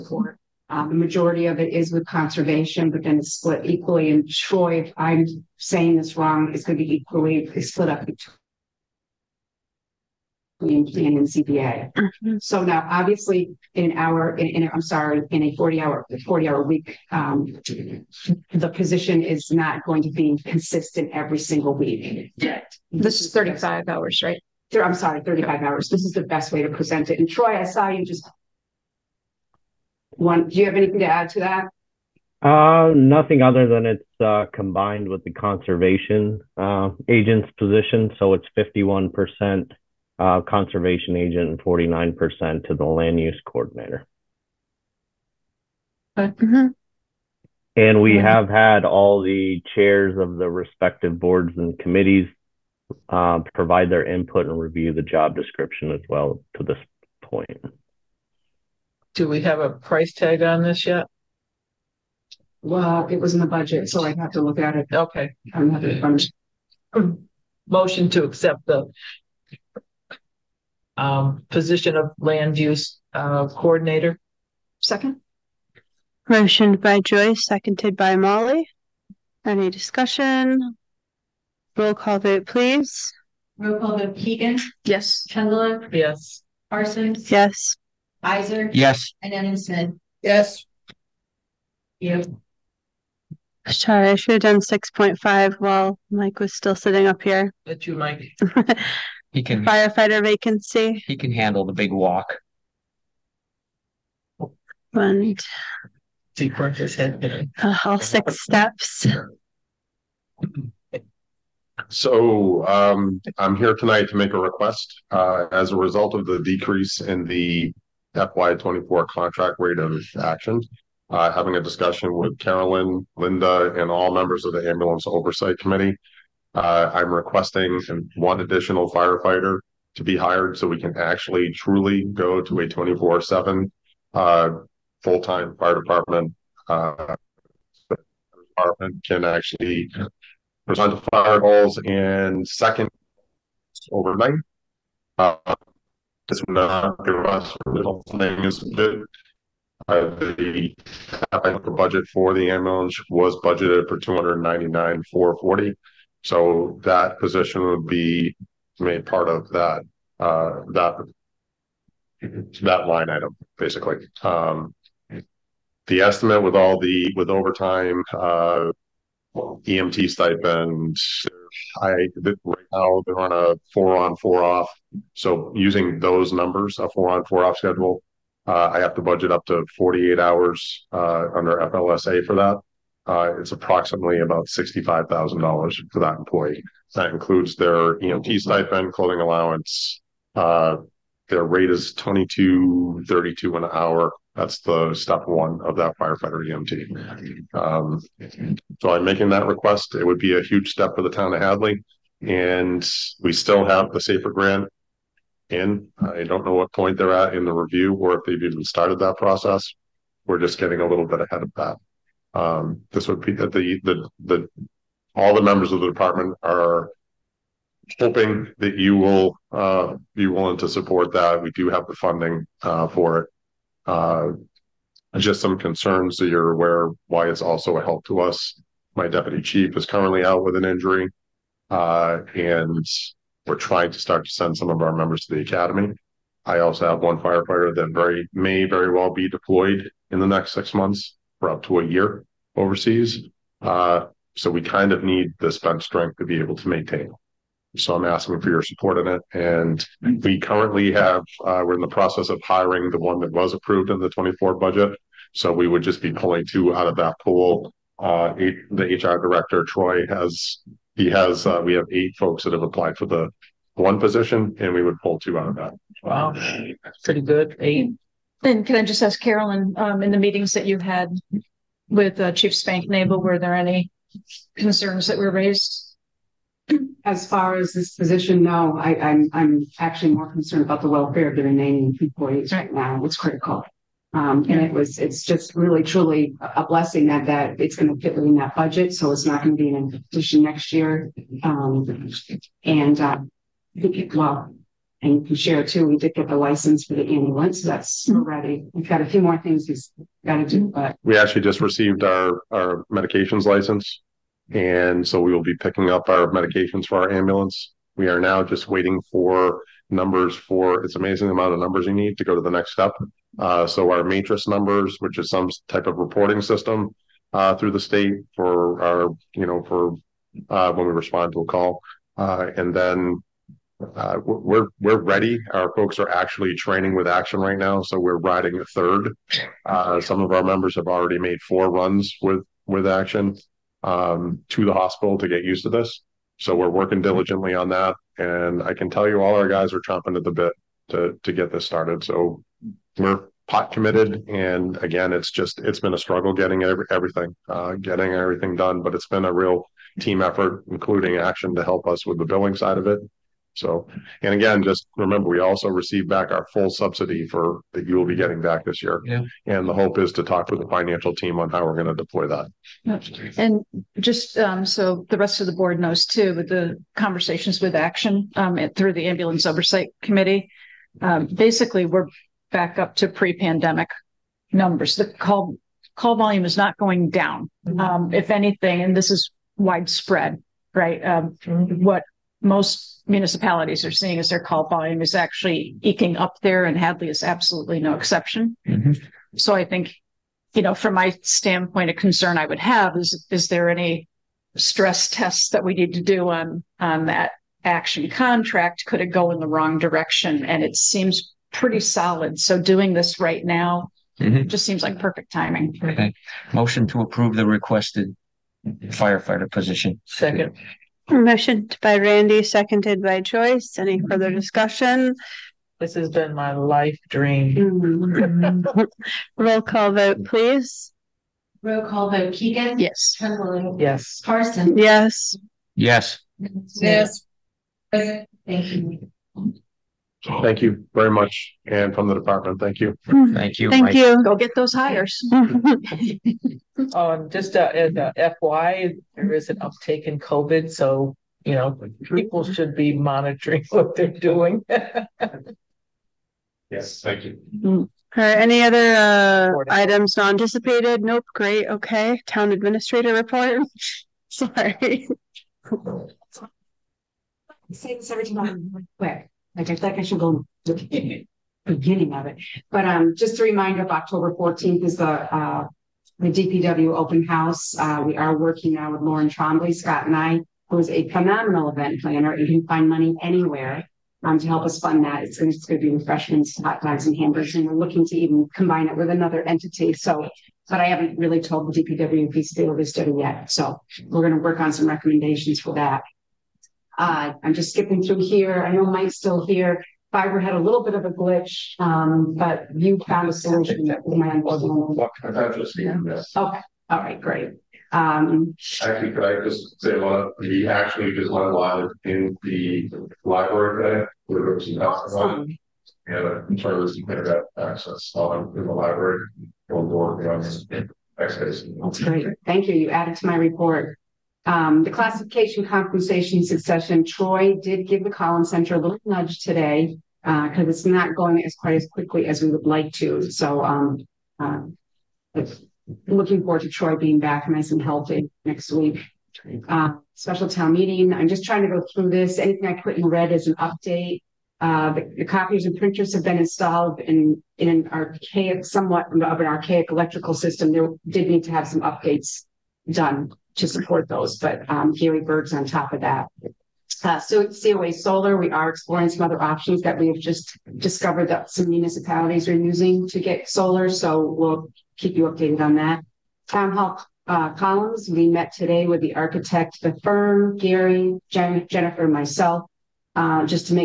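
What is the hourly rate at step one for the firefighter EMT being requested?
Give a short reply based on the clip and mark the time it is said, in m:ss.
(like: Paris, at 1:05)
22.32, at 3:11.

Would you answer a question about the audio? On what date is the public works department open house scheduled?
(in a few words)
October 14.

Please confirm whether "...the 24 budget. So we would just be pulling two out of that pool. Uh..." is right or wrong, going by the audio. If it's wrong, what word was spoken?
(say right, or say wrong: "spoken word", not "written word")
right.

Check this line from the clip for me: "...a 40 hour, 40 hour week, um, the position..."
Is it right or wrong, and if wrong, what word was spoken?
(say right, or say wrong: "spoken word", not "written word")
right.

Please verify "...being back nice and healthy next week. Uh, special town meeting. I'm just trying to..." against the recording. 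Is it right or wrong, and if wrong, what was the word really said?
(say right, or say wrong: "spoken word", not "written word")
right.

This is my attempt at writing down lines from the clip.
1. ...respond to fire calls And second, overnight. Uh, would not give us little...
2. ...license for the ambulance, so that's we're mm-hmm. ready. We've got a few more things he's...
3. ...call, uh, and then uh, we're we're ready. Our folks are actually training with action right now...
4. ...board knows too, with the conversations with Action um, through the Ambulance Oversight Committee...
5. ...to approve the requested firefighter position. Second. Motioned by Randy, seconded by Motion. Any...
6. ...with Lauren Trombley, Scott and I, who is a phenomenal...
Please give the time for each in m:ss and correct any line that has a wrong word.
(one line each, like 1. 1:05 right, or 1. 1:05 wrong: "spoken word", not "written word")
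1. 2:20 right
2. 4:56 right
3. 5:21 right
4. 6:05 right
5. 6:46 wrong: "Joyce", not "Motion"
6. 7:48 right.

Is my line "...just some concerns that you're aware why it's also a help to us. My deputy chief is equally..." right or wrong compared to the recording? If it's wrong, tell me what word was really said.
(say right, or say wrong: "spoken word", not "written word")
wrong: "currently", not "equally".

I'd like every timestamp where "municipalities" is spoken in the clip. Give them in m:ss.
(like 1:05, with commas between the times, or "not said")
6:23, 9:11.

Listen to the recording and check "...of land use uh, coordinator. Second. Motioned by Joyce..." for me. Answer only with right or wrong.
right.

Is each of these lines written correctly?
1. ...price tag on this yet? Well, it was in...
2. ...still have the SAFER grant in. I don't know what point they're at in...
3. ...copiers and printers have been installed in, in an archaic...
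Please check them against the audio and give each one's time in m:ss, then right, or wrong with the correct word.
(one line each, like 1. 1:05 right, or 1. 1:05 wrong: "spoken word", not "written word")
1. 0:59 right
2. 3:23 right
3. 8:55 right.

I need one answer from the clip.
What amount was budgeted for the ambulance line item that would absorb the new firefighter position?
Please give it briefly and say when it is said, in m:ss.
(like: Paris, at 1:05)
299,440, at 2:33.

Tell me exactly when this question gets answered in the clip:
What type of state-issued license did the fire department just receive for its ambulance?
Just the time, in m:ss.
5:02.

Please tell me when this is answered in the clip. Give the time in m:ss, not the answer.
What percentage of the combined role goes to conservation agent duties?
0:38.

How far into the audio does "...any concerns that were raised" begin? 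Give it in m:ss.
4:33.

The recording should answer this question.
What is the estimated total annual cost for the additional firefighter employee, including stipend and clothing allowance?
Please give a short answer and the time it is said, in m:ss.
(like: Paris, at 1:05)
$65,000, at 3:04.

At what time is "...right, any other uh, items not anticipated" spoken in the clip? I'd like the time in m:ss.
7:28.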